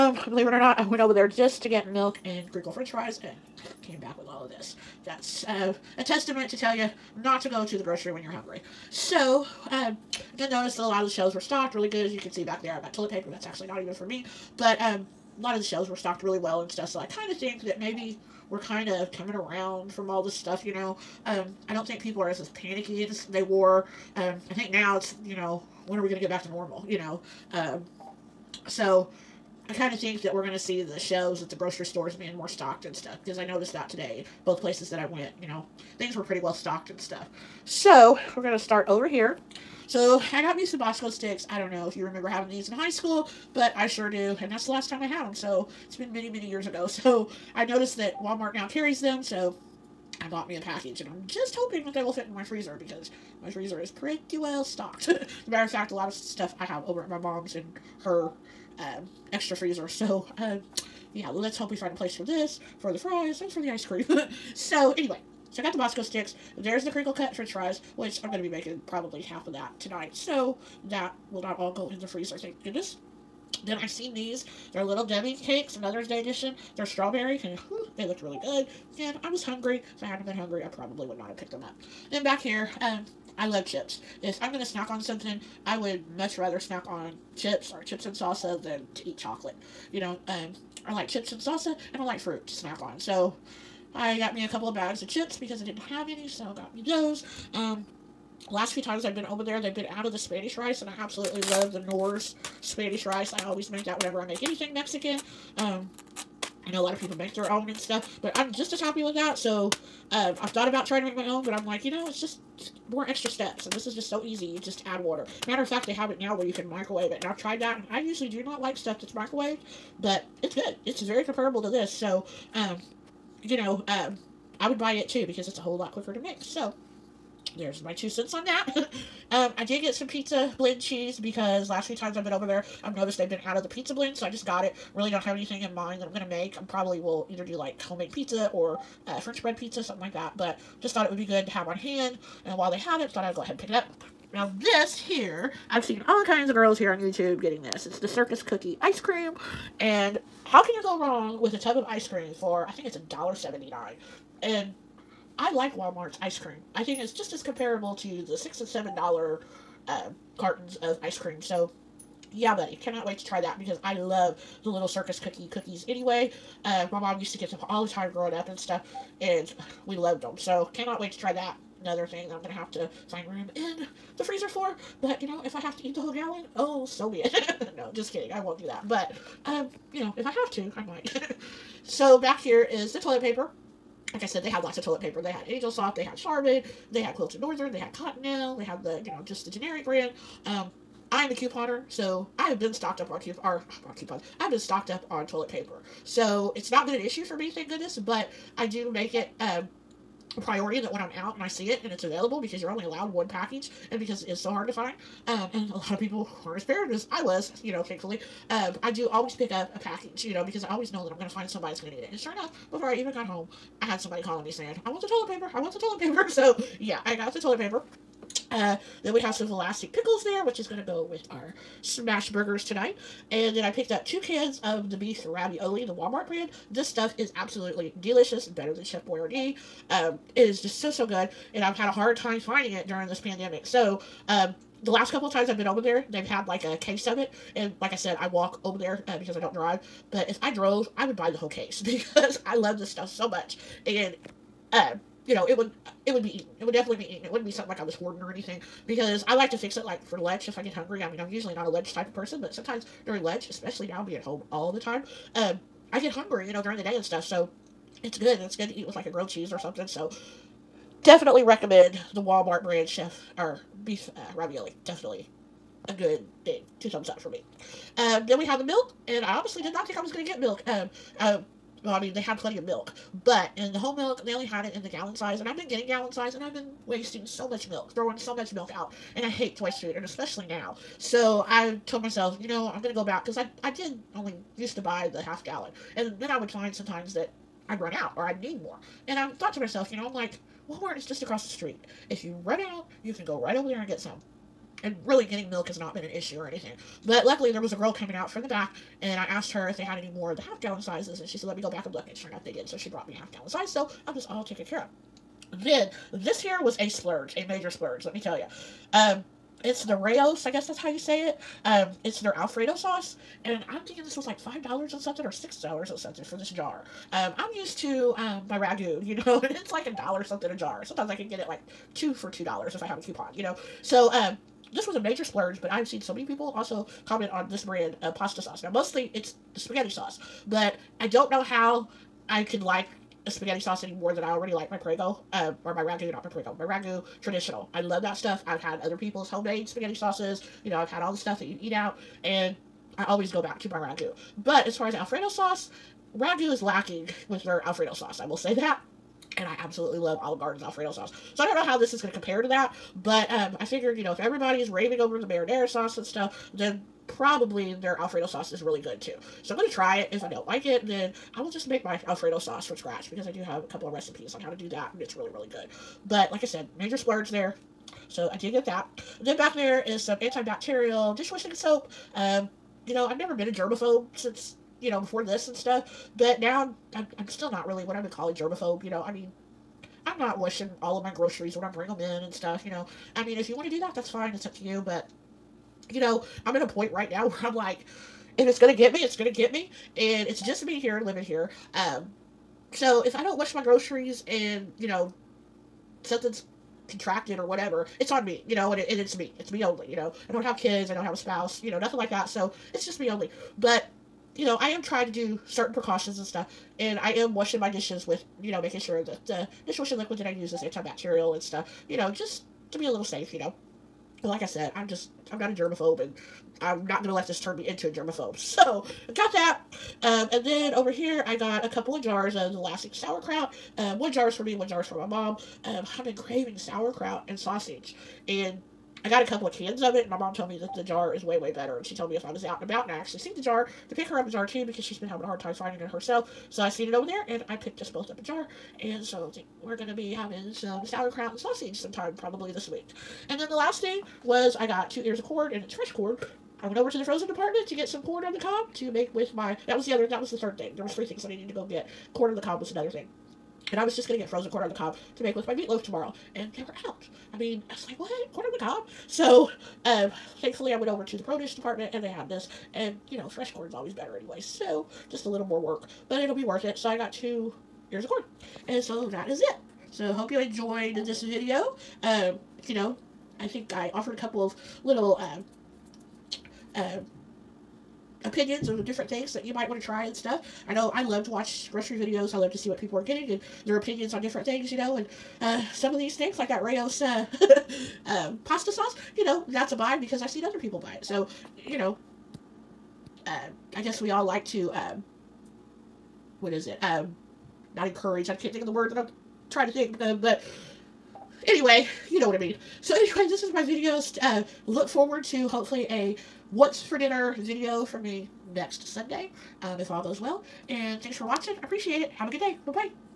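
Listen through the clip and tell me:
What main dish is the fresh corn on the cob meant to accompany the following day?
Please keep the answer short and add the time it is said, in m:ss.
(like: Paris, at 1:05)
Meatloaf, at 7:35.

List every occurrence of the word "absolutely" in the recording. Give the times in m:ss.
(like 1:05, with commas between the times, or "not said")
1:40, 3:47, 5:49.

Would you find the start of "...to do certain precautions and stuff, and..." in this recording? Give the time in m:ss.
6:45.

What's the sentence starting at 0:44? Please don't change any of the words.
And that's the last time I had them, so it's been many, many years ago.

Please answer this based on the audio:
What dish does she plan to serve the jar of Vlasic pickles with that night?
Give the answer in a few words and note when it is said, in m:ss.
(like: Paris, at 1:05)
Smash burgers, at 3:41.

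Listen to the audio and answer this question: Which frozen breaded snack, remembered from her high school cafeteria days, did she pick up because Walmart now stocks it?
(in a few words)
Bosco sticks.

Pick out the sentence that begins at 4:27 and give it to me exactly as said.
Um, then we have the milk, and I honestly did not think I was going to get milk.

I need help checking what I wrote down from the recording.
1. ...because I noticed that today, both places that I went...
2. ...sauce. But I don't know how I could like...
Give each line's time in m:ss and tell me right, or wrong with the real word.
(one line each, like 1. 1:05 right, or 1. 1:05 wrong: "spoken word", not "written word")
1. 0:33 right
2. 5:29 right.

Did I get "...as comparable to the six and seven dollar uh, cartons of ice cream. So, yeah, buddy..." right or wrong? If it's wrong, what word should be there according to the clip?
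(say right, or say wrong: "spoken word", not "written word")
right.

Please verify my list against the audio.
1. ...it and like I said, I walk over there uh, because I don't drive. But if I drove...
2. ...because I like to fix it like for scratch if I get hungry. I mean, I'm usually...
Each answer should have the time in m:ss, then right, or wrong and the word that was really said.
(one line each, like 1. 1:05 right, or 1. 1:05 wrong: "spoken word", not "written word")
1. 3:57 right
2. 4:08 wrong: "lunch", not "scratch".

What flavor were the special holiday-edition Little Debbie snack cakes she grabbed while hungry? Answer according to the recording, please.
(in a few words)
Strawberry.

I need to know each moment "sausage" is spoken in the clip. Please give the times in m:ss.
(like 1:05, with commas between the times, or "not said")
7:07, 7:21.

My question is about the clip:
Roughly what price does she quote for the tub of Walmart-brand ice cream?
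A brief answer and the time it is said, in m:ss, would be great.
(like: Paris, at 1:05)
$1.79, at 2:32.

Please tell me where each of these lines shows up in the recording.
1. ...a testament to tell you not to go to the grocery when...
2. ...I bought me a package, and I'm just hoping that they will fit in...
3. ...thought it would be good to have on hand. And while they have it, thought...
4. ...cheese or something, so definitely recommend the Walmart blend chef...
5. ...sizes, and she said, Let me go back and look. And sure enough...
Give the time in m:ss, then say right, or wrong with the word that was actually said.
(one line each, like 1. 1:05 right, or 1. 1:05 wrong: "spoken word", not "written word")
1. 0:05 right
2. 0:50 right
3. 2:20 right
4. 4:19 wrong: "brand", not "blend"
5. 5:00 right.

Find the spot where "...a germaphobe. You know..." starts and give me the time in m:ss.
6:18.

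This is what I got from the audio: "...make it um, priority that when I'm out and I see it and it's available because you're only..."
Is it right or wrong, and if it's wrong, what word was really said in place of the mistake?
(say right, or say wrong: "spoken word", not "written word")
right.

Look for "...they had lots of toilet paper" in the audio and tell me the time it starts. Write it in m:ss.
3:04.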